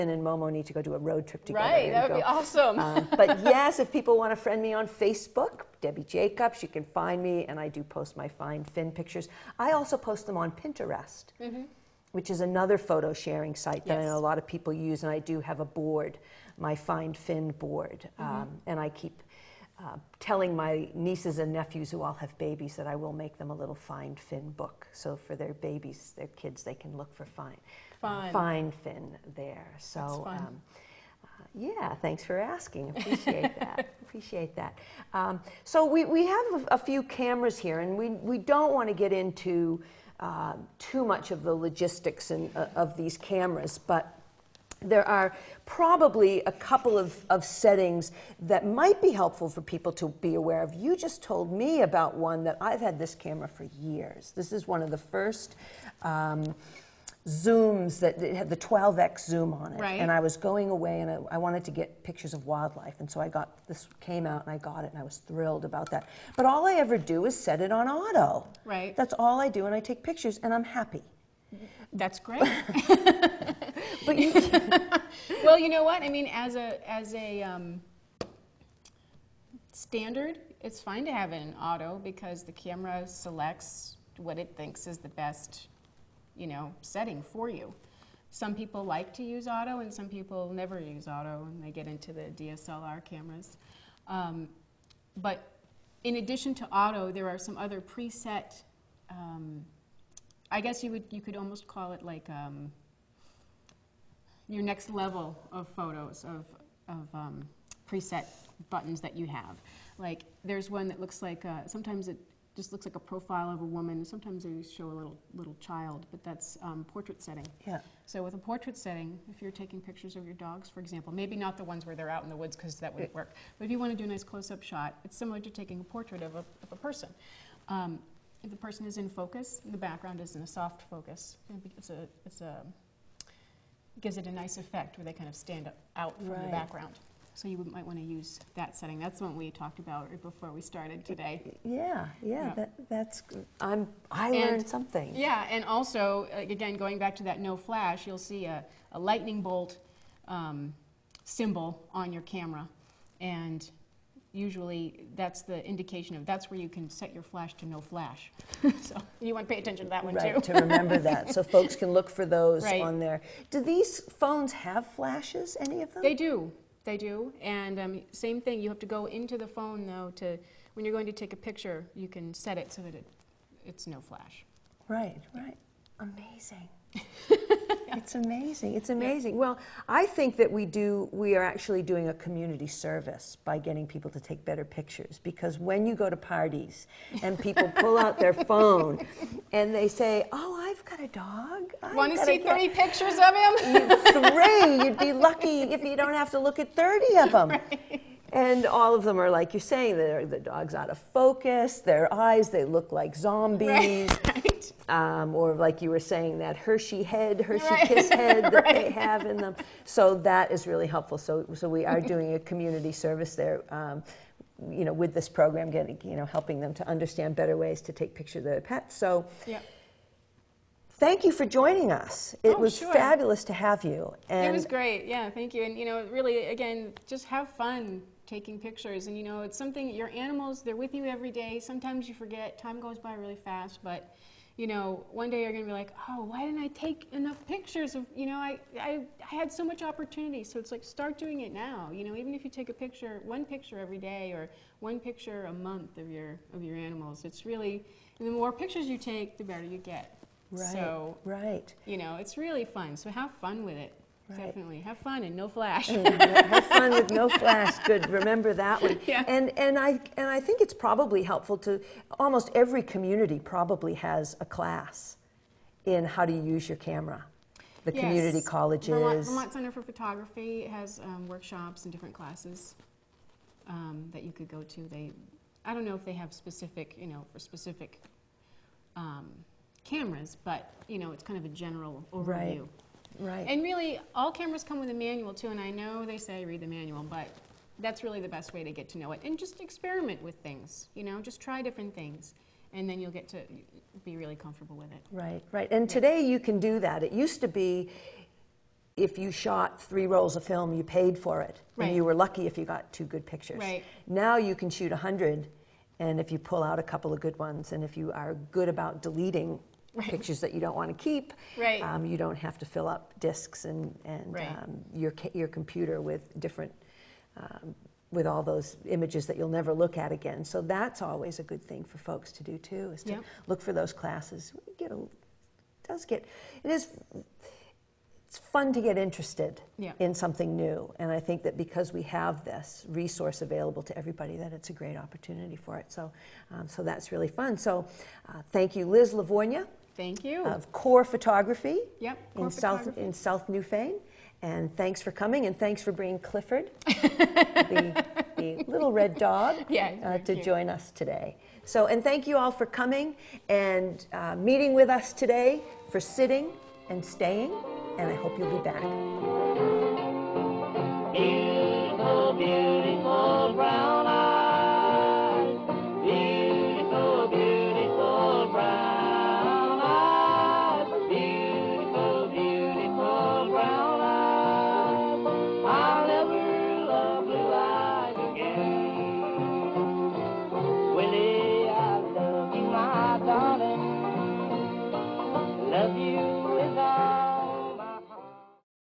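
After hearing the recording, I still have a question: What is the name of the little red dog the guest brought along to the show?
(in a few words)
Clifford.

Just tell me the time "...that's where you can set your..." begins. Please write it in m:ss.
2:36.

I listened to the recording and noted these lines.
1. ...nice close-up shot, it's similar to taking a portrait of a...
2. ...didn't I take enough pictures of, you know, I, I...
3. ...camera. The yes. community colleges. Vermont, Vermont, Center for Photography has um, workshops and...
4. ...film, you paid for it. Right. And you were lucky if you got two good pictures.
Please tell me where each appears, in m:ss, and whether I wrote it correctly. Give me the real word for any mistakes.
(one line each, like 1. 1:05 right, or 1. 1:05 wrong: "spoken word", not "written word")
1. 2:04 right
2. 3:56 right
3. 4:26 right
4. 5:00 right.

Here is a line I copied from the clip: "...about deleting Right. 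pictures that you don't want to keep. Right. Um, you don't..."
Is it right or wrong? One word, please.
right.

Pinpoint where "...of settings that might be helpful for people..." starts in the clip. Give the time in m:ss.
0:47.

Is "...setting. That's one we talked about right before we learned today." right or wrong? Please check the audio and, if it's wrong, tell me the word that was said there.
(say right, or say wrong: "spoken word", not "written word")
wrong: "started", not "learned".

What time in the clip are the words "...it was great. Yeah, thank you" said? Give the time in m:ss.
3:44.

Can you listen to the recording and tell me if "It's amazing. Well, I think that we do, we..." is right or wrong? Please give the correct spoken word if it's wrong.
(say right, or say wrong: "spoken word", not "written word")
right.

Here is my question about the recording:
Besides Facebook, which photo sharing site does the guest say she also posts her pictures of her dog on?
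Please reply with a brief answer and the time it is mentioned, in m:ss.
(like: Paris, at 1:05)
Pinterest, at 0:10.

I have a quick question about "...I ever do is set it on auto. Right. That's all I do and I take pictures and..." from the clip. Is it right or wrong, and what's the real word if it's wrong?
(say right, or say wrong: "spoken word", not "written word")
right.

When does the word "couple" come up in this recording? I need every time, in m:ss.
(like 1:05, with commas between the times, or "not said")
0:46, 5:06.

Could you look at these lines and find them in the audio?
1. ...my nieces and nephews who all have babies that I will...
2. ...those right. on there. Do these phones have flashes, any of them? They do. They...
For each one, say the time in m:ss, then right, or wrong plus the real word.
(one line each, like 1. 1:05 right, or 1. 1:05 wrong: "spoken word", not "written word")
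1. 0:20 right
2. 2:42 right.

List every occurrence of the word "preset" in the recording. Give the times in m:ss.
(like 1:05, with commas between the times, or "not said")
1:37, 1:47.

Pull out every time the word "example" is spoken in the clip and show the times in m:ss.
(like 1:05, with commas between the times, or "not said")
2:00.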